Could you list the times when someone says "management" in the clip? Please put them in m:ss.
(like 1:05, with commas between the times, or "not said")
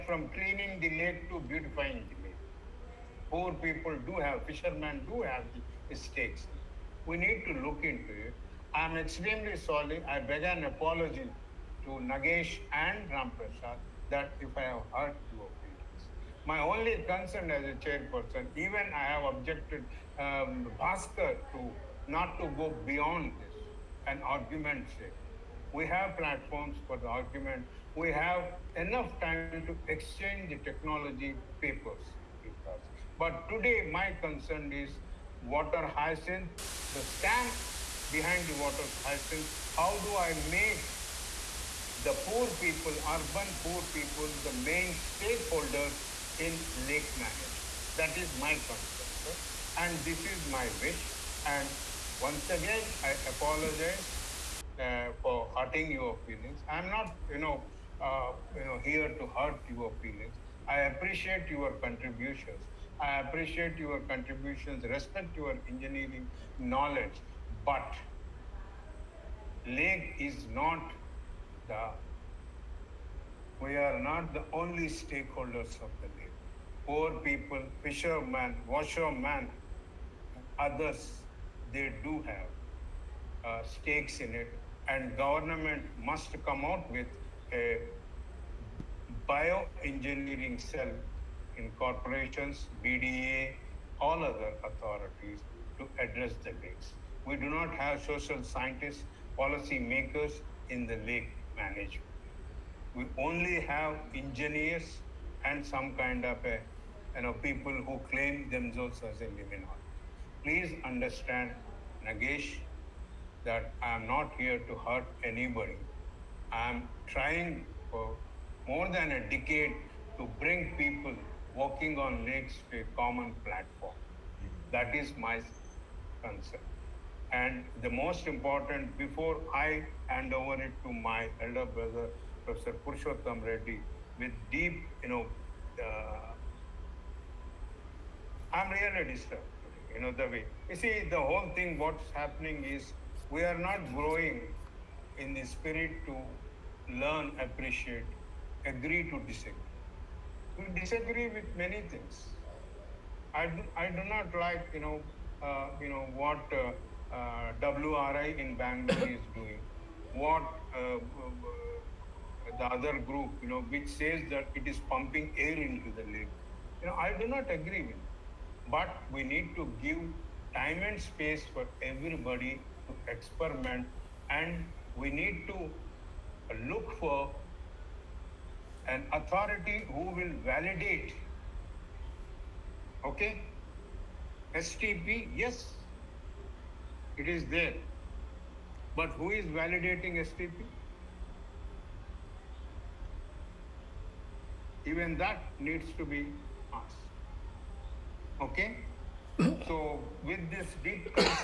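0:47, 1:41.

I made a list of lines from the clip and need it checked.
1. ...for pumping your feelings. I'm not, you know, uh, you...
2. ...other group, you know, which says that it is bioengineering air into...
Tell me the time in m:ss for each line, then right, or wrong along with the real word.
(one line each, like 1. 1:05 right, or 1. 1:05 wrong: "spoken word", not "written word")
1. 0:55 wrong: "hurting", not "pumping"
2. 2:42 wrong: "pumping", not "bioengineering".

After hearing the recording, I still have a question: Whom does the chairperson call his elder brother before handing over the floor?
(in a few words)
Purushottam Reddy.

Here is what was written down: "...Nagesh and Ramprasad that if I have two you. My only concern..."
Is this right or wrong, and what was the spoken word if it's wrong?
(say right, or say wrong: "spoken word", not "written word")
right.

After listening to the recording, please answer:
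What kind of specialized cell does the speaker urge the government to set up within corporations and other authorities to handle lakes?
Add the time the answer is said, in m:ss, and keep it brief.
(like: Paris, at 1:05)
Bioengineering cell, at 1:29.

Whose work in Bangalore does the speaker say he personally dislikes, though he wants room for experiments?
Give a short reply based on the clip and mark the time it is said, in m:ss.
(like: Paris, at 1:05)
WRI, at 2:37.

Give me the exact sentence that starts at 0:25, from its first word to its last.
We have platforms for the argument.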